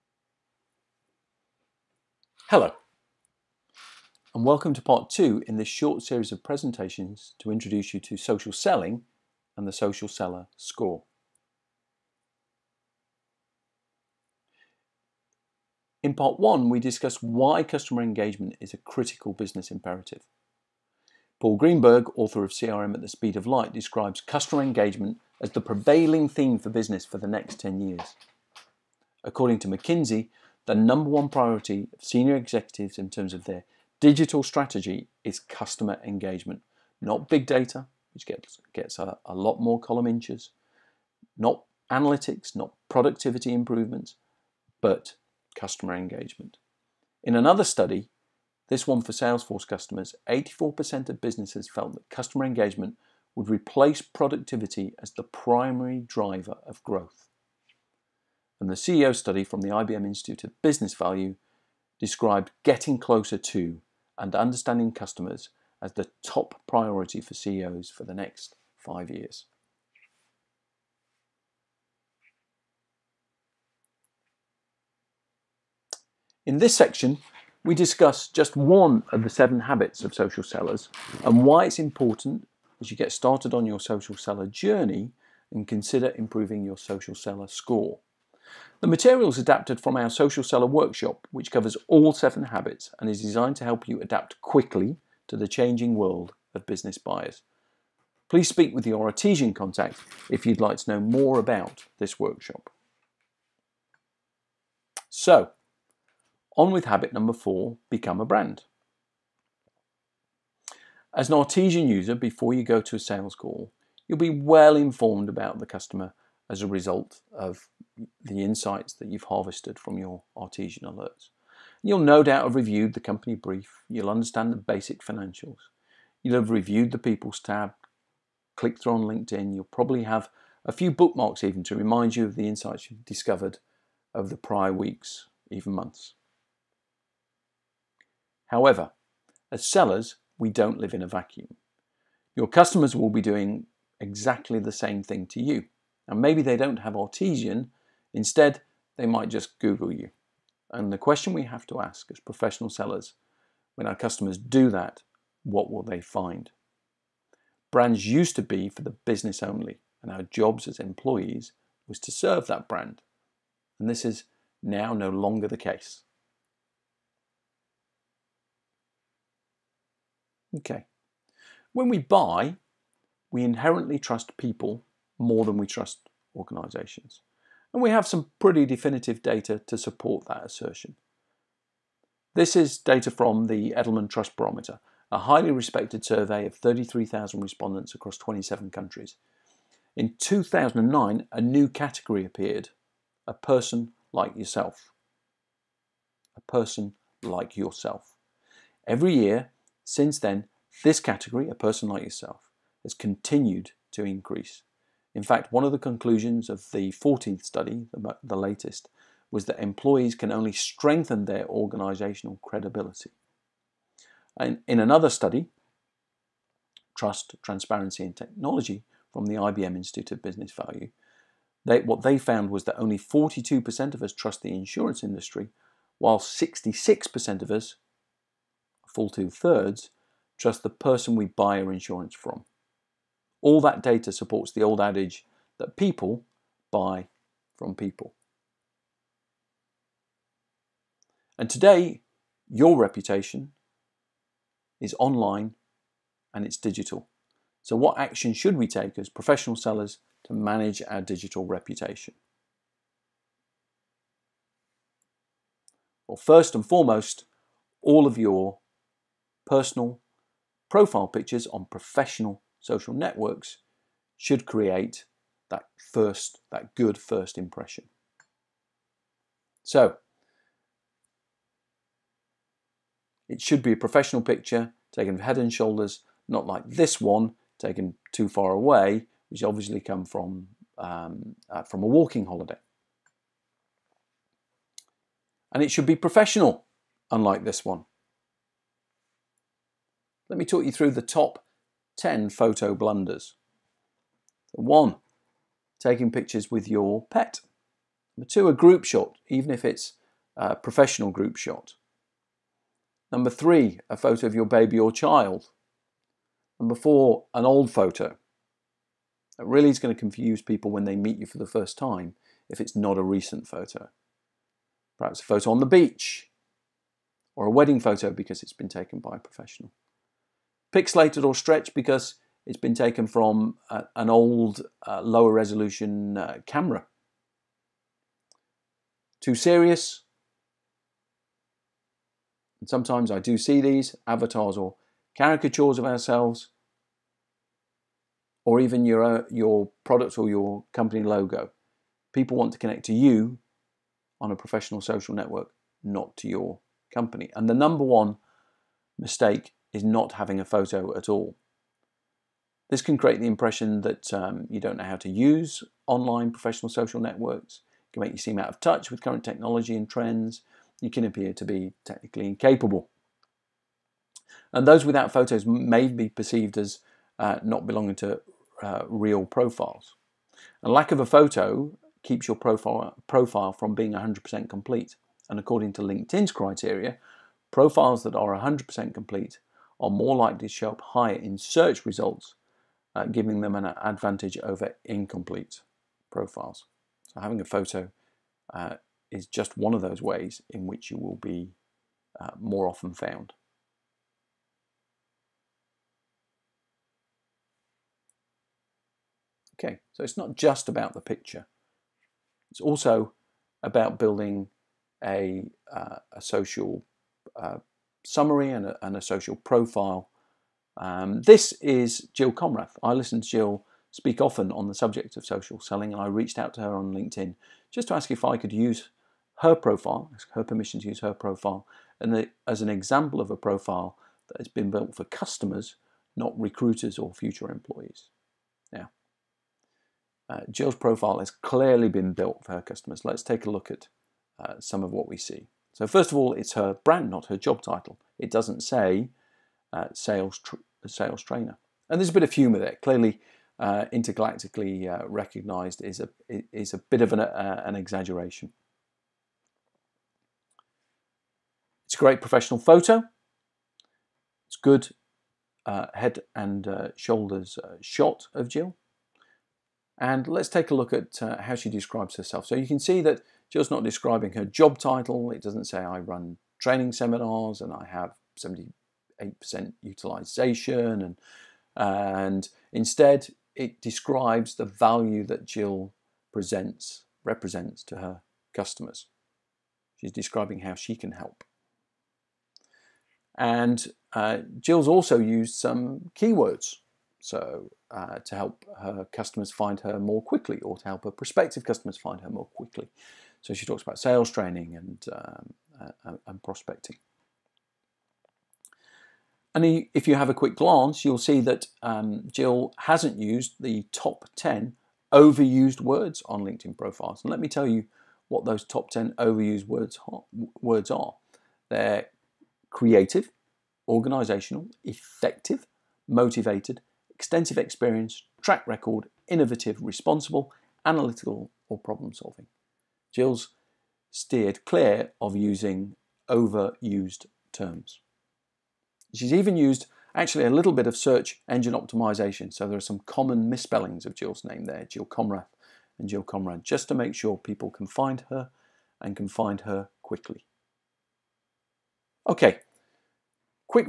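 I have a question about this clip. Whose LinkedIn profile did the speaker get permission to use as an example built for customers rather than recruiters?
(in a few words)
Jill Konrath.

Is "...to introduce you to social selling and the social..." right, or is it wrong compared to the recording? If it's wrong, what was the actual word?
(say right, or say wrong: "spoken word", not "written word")
right.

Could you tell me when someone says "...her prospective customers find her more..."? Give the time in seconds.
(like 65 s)
491 s.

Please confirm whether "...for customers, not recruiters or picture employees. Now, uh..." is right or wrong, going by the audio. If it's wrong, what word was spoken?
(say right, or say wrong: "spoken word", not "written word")
wrong: "future", not "picture".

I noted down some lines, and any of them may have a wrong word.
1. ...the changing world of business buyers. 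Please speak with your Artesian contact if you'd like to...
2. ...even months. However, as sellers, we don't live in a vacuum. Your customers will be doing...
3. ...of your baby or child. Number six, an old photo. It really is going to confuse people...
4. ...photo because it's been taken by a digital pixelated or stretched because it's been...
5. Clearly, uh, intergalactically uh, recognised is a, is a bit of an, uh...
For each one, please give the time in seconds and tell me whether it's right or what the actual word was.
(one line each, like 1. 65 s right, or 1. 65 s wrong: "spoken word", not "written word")
1. 95 s right
2. 135 s right
3. 304 s wrong: "four", not "six"
4. 317 s wrong: "professional", not "digital"
5. 442 s right.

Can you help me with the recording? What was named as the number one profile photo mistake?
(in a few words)
your pet.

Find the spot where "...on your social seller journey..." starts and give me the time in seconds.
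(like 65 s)
83 s.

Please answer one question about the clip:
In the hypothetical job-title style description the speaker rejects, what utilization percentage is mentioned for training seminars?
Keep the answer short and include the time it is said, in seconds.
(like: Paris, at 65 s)
78%, at 468 s.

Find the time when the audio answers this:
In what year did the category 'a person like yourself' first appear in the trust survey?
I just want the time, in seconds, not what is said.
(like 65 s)
190 s.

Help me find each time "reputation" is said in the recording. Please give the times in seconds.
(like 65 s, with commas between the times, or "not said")
242 s, 251 s.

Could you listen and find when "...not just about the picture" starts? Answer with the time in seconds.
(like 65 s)
400 s.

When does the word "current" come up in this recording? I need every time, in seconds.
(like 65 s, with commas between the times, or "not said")
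359 s.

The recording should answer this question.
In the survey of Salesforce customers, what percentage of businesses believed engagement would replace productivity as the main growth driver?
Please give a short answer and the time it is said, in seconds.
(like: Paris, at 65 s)
84%, at 50 s.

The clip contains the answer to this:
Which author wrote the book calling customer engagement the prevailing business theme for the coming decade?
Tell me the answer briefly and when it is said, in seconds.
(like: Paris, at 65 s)
Paul Greenberg, at 21 s.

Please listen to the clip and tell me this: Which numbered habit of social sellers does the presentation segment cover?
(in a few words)
4.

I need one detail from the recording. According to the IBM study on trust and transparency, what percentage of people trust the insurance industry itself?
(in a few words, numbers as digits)
42%.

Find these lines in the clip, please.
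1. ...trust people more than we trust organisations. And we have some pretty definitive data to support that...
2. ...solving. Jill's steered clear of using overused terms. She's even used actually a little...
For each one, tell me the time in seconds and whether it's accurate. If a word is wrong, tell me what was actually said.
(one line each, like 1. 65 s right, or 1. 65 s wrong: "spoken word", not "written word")
1. 173 s right
2. 522 s right.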